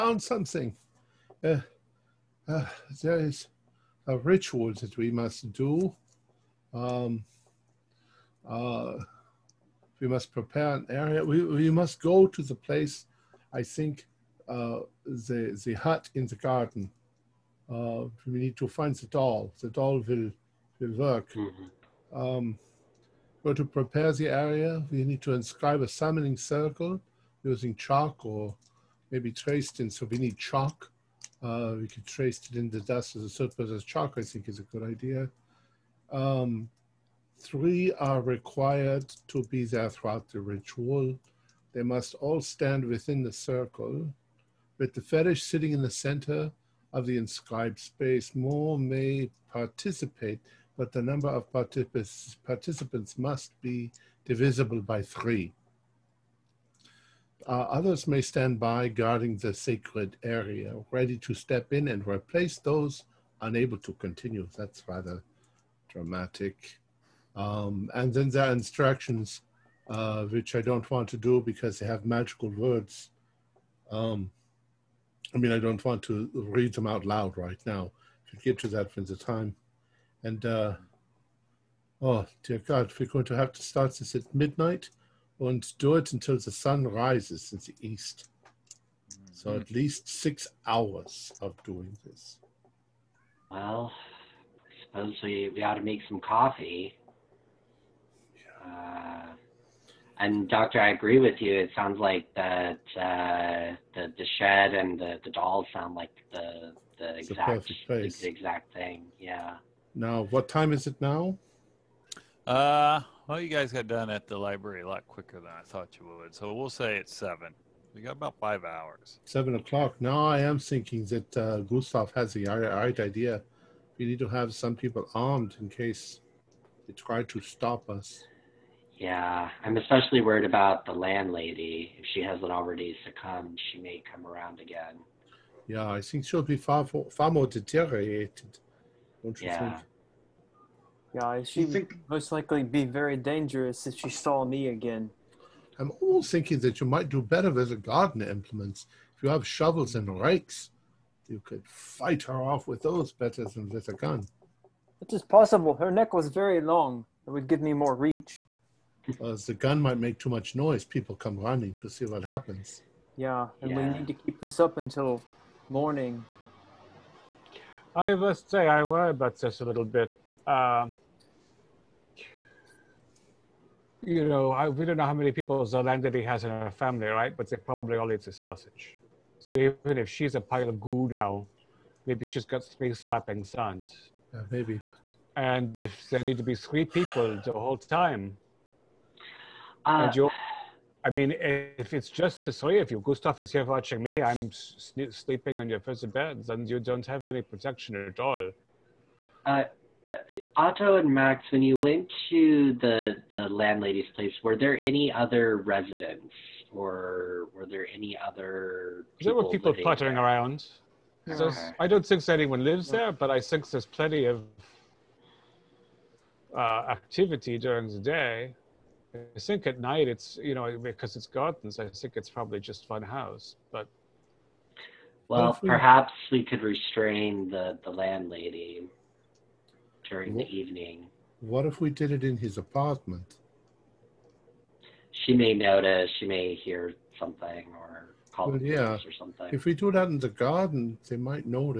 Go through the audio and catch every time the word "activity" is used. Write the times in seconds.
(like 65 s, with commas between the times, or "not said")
216 s.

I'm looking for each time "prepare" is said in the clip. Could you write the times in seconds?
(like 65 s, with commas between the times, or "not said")
10 s, 23 s.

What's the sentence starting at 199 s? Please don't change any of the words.
Uh, uh, Otto and Max, when you went to the, the landlady's place, were there any other residents?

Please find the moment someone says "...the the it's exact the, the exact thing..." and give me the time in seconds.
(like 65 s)
106 s.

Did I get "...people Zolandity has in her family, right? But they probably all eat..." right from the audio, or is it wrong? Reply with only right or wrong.
right.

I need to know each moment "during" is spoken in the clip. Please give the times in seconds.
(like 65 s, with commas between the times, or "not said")
217 s, 230 s.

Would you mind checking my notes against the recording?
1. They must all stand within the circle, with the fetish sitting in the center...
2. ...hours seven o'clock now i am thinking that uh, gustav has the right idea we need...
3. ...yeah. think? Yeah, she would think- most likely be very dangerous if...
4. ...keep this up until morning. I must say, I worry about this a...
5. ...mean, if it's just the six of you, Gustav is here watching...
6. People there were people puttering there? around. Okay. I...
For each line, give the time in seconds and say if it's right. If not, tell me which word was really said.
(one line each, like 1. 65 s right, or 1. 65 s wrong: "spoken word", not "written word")
1. 41 s right
2. 118 s right
3. 139 s right
4. 164 s right
5. 191 s wrong: "three", not "six"
6. 209 s right.